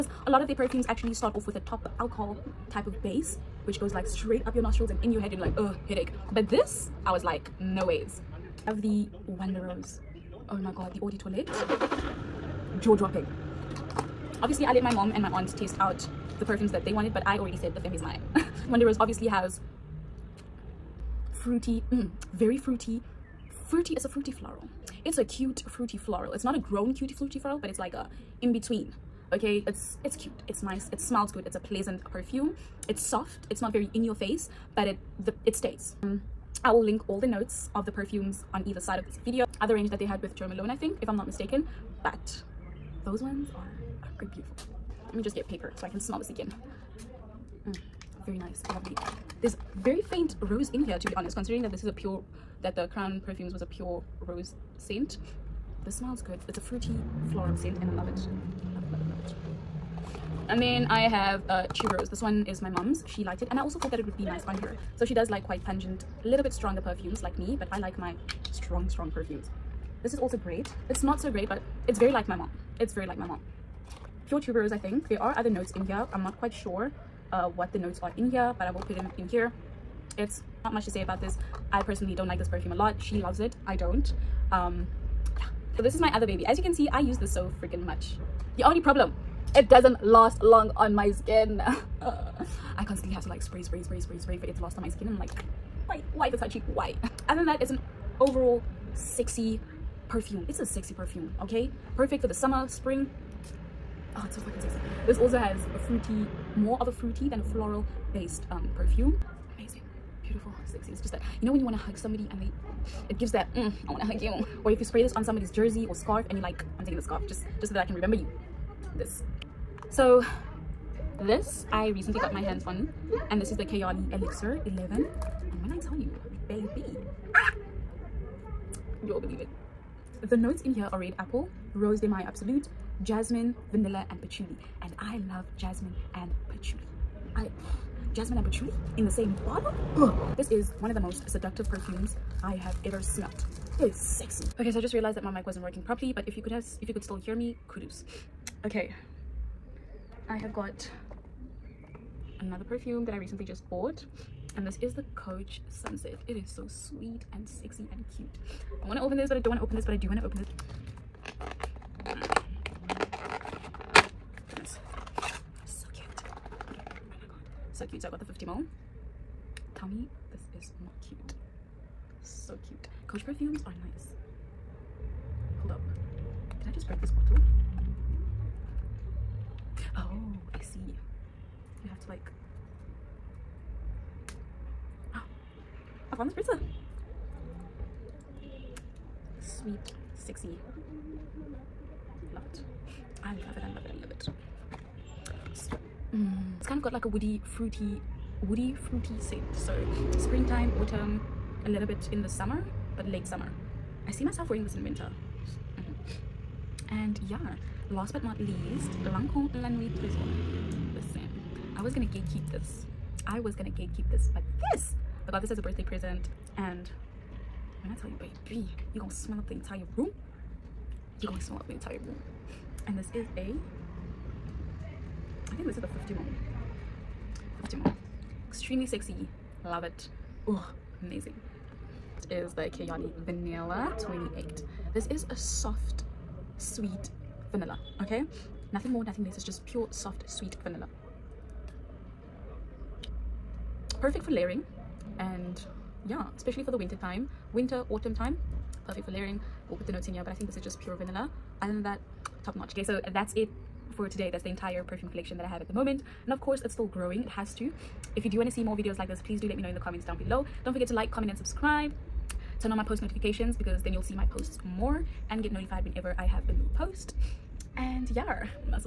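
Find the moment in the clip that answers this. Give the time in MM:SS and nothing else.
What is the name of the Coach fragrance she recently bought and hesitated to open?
02:35.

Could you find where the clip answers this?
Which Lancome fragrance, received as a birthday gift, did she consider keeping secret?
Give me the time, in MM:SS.
03:29.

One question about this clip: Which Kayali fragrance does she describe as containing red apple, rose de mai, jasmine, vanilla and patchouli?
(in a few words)
Kayali Elixir 11.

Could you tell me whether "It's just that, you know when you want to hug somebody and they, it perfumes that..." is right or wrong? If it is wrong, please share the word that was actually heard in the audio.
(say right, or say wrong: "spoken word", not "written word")
wrong: "gives", not "perfumes".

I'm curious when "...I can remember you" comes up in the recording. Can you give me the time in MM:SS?
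01:57.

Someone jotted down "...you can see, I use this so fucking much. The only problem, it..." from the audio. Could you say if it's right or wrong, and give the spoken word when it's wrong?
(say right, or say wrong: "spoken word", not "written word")
wrong: "freaking", not "fucking".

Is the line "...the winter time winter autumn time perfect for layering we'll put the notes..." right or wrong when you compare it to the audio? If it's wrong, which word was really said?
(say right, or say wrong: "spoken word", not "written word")
right.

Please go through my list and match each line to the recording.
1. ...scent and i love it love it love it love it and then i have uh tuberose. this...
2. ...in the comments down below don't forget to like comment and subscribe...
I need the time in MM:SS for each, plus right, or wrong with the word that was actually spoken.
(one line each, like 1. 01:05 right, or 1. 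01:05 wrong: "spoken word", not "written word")
1. 00:57 right
2. 04:19 right.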